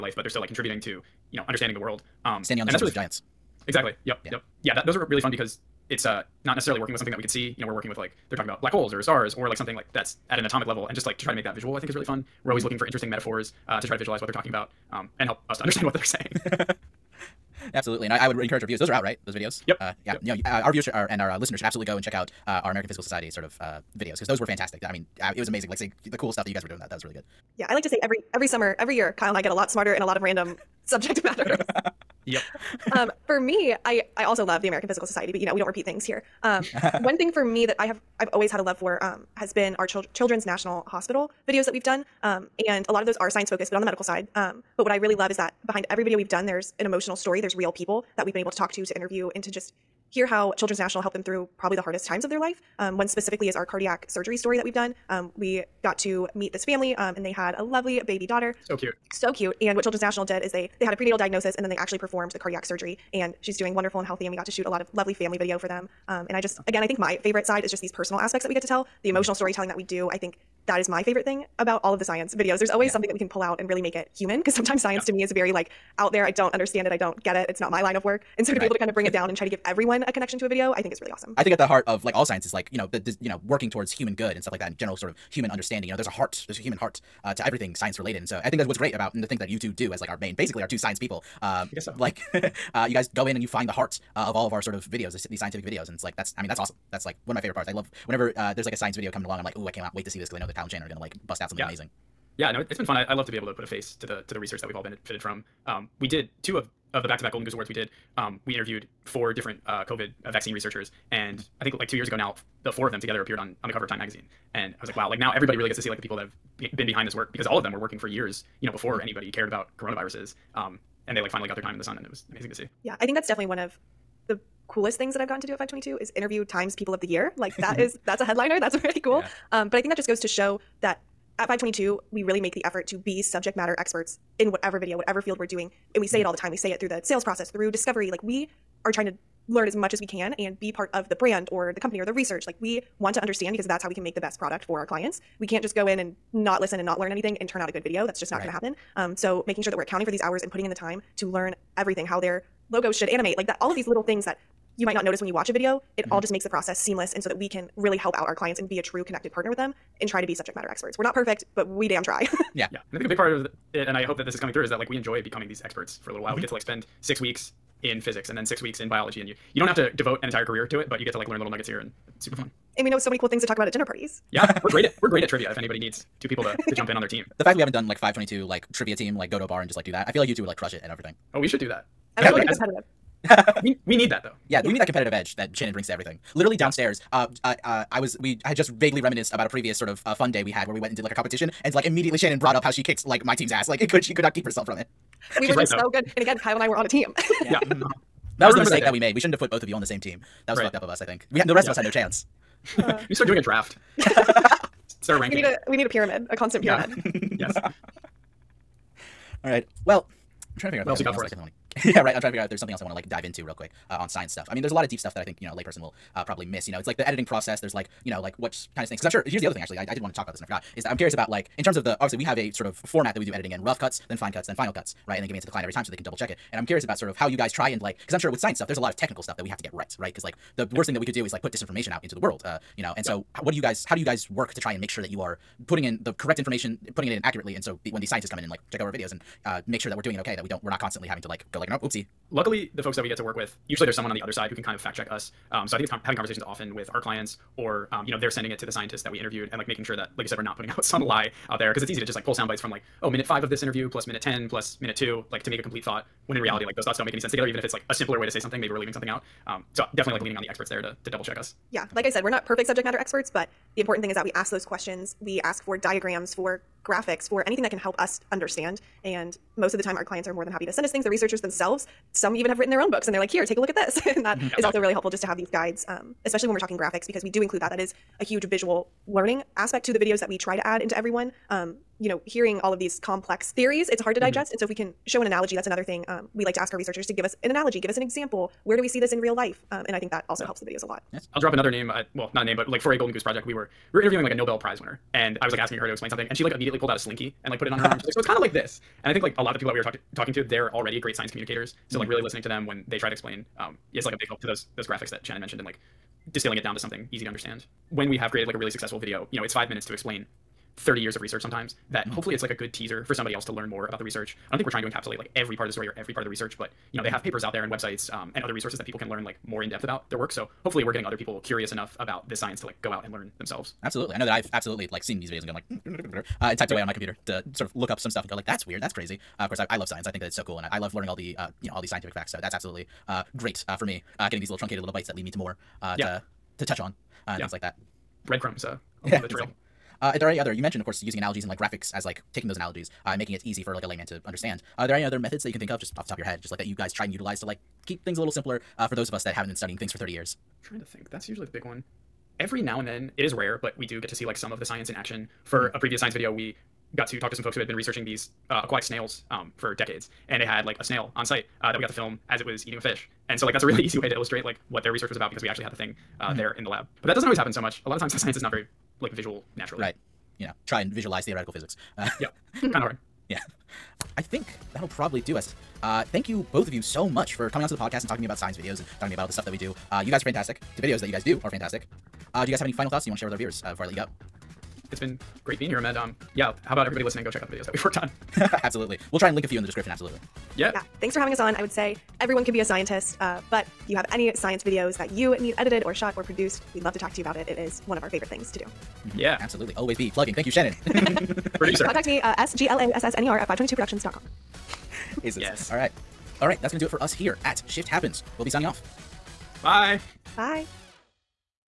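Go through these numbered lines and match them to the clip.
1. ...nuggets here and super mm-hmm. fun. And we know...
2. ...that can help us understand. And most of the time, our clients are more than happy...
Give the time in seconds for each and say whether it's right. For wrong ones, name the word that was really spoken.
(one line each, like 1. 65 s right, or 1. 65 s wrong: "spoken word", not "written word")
1. 171 s right
2. 267 s right.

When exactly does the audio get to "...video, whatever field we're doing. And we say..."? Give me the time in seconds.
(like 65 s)
134 s.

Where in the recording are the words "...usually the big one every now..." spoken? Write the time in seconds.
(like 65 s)
351 s.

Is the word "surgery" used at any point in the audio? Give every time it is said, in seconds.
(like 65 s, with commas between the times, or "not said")
54 s, 62 s.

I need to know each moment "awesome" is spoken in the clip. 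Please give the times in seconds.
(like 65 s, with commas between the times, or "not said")
81 s, 96 s.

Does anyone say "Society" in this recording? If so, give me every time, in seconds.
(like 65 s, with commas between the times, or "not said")
23 s, 35 s.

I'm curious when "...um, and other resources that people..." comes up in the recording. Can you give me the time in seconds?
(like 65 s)
318 s.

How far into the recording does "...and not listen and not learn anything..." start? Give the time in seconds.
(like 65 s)
145 s.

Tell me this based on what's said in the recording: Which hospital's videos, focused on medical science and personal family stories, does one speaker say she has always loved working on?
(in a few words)
Children's National Hospital.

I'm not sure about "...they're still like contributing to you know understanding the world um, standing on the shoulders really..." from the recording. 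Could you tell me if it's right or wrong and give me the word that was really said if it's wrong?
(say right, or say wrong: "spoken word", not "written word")
right.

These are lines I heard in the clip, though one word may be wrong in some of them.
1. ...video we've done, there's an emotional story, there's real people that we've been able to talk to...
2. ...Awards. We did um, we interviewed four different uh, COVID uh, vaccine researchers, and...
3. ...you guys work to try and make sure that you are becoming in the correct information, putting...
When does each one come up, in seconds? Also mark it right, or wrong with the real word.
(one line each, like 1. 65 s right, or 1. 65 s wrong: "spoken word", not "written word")
1. 46 s right
2. 107 s right
3. 233 s wrong: "putting", not "becoming".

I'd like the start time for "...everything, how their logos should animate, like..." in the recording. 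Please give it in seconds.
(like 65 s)
151 s.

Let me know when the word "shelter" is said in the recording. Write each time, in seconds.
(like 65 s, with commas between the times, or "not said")
not said.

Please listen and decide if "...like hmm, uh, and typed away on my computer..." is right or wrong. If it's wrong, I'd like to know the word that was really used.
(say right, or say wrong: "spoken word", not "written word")
right.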